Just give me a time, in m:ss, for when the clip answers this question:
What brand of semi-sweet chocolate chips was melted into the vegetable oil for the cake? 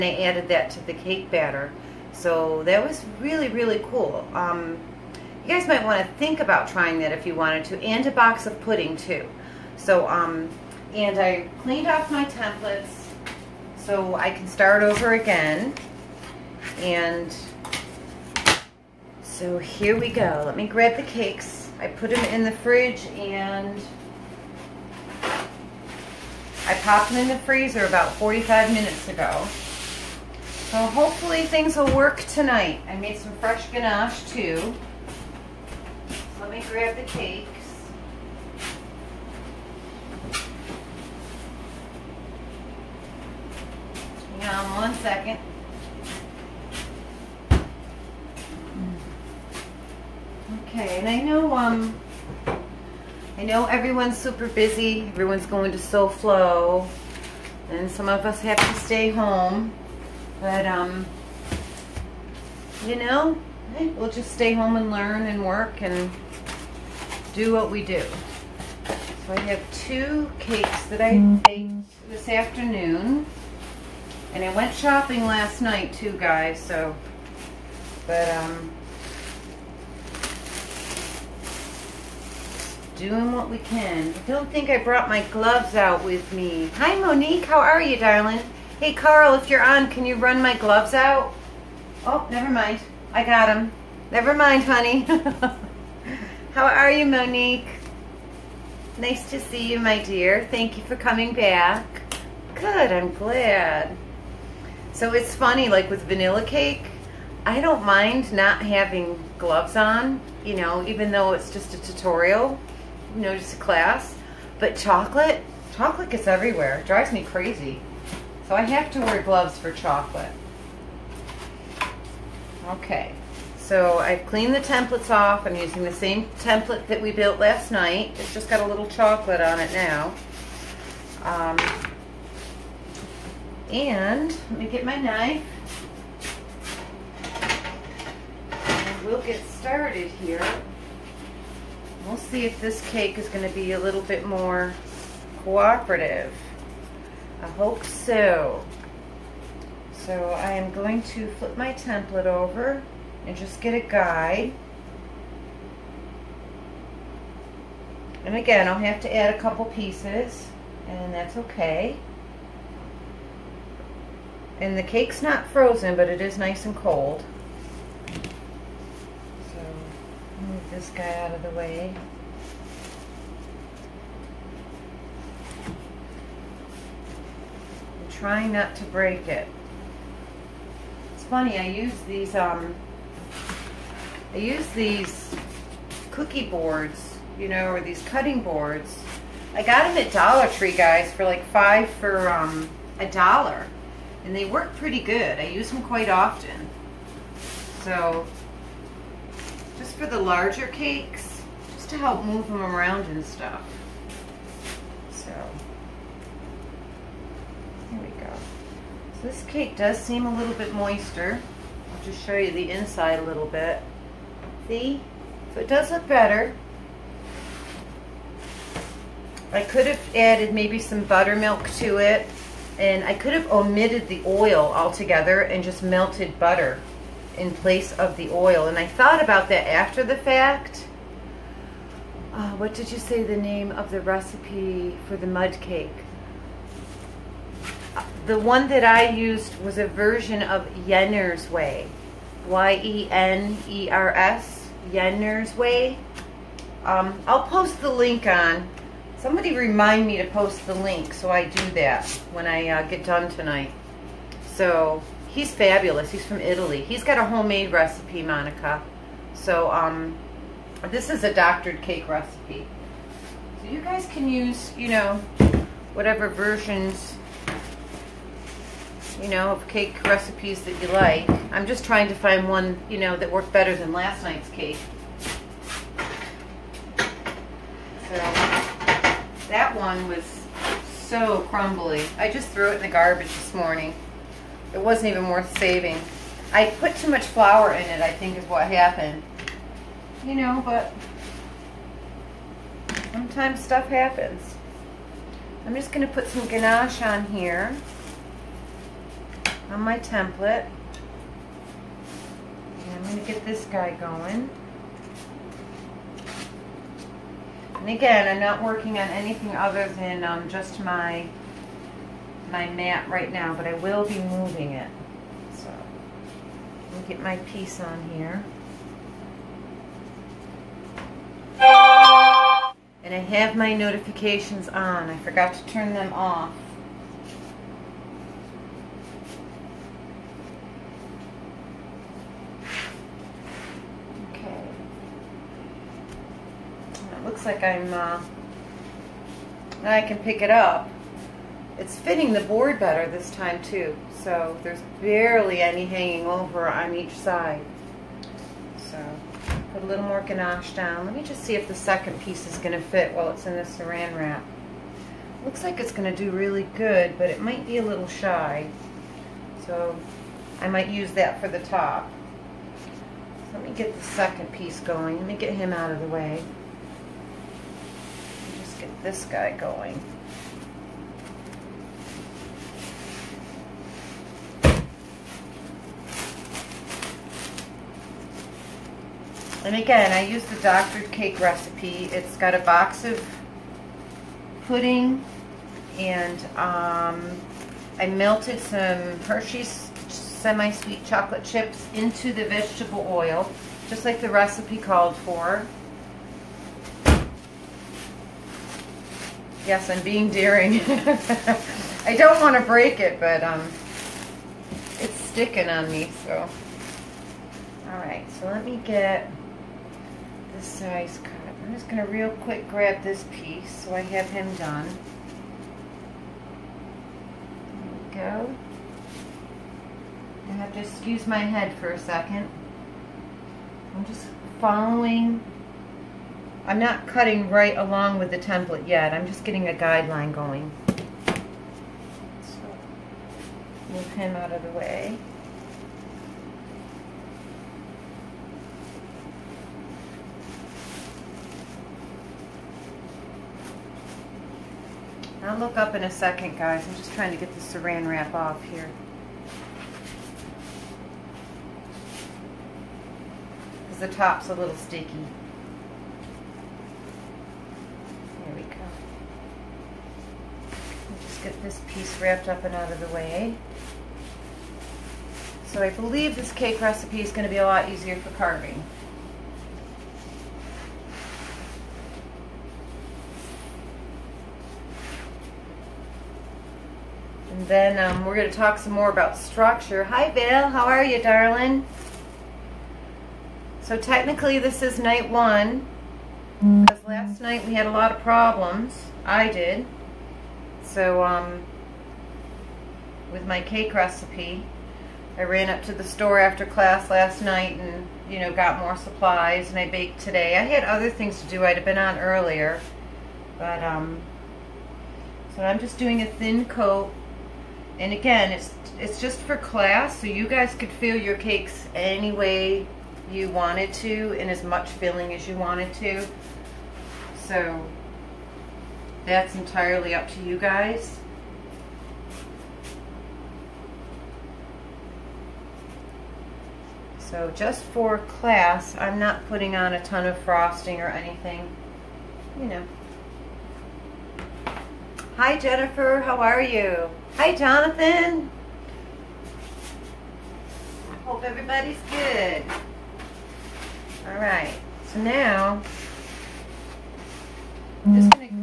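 6:29.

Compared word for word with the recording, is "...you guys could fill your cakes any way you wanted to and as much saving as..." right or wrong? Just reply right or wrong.
wrong.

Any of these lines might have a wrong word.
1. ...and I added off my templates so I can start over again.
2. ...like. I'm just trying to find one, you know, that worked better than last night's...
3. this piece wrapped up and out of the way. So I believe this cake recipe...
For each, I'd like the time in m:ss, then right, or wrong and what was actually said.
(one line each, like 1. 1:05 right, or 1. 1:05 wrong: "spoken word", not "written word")
1. 0:10 wrong: "cleaned", not "added"
2. 4:30 right
3. 7:41 right.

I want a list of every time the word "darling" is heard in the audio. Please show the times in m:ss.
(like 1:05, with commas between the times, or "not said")
1:27, 8:01.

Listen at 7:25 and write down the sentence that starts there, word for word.
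I'll look up in a second, guys.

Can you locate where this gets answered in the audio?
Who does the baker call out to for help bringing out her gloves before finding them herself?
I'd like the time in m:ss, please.
1:28.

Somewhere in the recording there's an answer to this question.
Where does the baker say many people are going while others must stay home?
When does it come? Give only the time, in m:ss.
0:55.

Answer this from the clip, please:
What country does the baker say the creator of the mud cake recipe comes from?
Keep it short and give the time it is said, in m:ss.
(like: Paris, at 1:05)
Italy, at 4:16.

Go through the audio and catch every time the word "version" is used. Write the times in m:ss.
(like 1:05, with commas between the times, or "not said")
3:59, 4:26.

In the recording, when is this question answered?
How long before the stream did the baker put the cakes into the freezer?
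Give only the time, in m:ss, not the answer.
0:28.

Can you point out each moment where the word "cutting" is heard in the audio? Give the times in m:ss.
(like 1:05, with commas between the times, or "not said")
3:08, 7:07.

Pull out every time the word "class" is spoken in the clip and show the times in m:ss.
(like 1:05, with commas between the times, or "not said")
1:53, 8:16, 8:29, 8:48.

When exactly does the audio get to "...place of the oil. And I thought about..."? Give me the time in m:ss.
3:47.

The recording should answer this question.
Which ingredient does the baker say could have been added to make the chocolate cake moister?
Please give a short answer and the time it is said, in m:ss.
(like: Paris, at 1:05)
buttermilk, at 3:41.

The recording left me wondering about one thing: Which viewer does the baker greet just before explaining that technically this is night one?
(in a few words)
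Bill.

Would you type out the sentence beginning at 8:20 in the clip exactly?
I had other things to do.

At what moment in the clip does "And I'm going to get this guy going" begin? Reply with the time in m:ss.
5:02.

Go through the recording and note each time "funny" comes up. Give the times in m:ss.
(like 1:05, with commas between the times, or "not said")
1:45, 3:01.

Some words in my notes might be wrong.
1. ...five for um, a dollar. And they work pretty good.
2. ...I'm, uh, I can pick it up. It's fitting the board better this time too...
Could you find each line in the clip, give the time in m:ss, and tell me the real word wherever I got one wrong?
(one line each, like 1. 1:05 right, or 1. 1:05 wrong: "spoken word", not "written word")
1. 3:11 right
2. 5:37 right.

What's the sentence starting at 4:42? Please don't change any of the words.
I just threw it in the garbage this morning.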